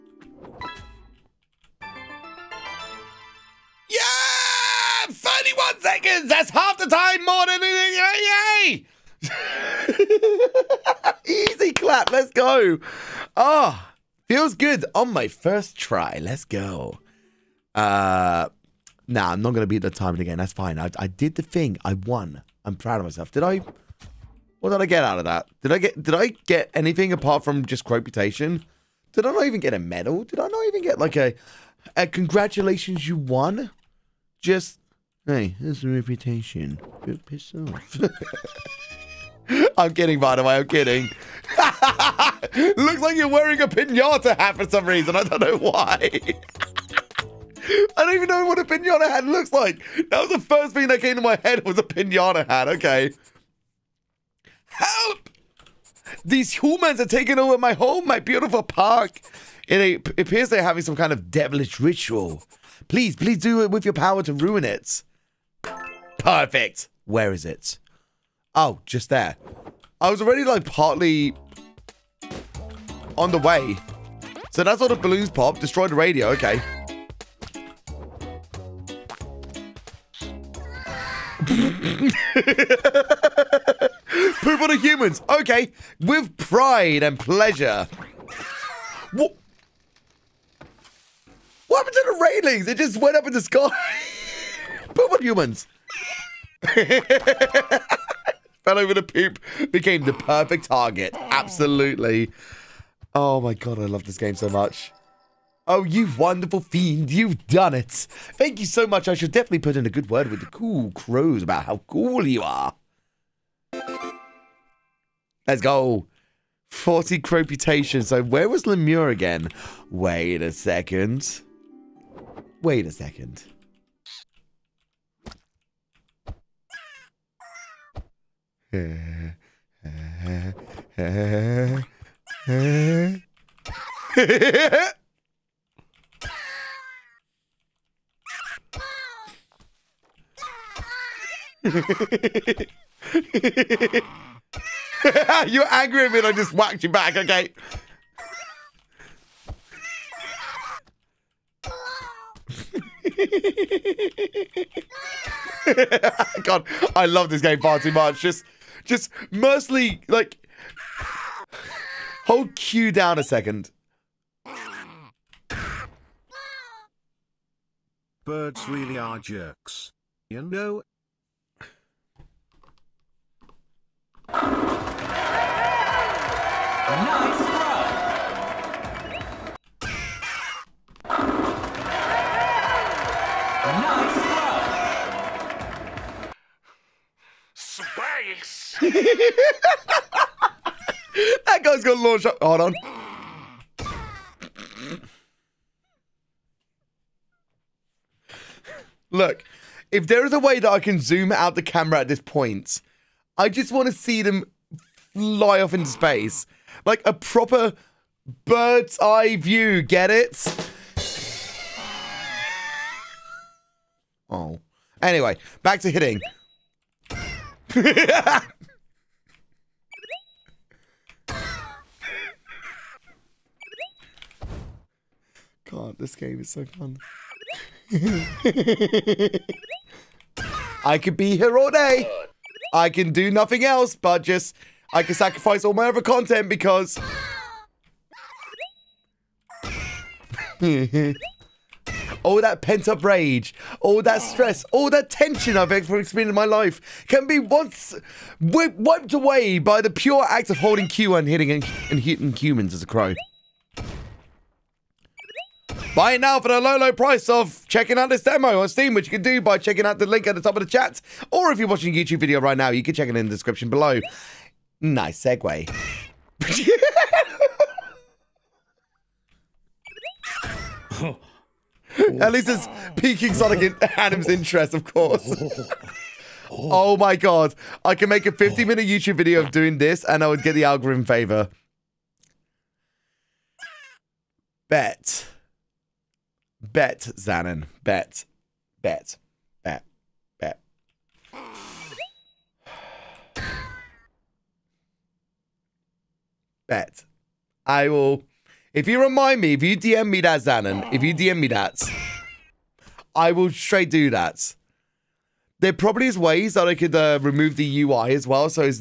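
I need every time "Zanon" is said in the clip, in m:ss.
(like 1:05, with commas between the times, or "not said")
4:47, 5:00.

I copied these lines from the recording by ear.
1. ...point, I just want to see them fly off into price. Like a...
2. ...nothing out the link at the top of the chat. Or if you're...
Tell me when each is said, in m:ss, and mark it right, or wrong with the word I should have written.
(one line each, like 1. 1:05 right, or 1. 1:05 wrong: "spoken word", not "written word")
1. 3:22 wrong: "space", not "price"
2. 4:19 wrong: "checking", not "nothing".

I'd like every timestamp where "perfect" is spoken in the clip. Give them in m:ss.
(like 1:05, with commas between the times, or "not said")
1:06, 1:40.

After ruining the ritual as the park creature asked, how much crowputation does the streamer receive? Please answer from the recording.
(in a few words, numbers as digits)
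40.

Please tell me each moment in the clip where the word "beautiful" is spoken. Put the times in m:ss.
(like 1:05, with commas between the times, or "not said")
0:58.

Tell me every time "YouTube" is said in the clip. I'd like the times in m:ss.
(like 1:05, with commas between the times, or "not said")
4:22, 4:38.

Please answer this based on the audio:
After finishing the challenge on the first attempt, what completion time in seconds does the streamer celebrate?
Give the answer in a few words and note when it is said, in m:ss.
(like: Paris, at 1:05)
31 seconds, at 0:05.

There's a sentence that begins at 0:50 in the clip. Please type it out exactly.
That was the first thing that came to my head was a pinata hat.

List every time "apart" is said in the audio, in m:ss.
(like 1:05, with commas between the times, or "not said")
0:27.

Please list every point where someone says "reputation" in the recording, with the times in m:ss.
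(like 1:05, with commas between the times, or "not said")
0:27, 0:35.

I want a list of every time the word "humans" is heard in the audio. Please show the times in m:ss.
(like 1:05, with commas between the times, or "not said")
0:56, 1:24, 1:35, 4:12.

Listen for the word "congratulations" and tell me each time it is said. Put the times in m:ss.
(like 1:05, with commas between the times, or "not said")
0:32.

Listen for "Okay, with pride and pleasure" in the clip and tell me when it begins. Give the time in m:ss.
1:25.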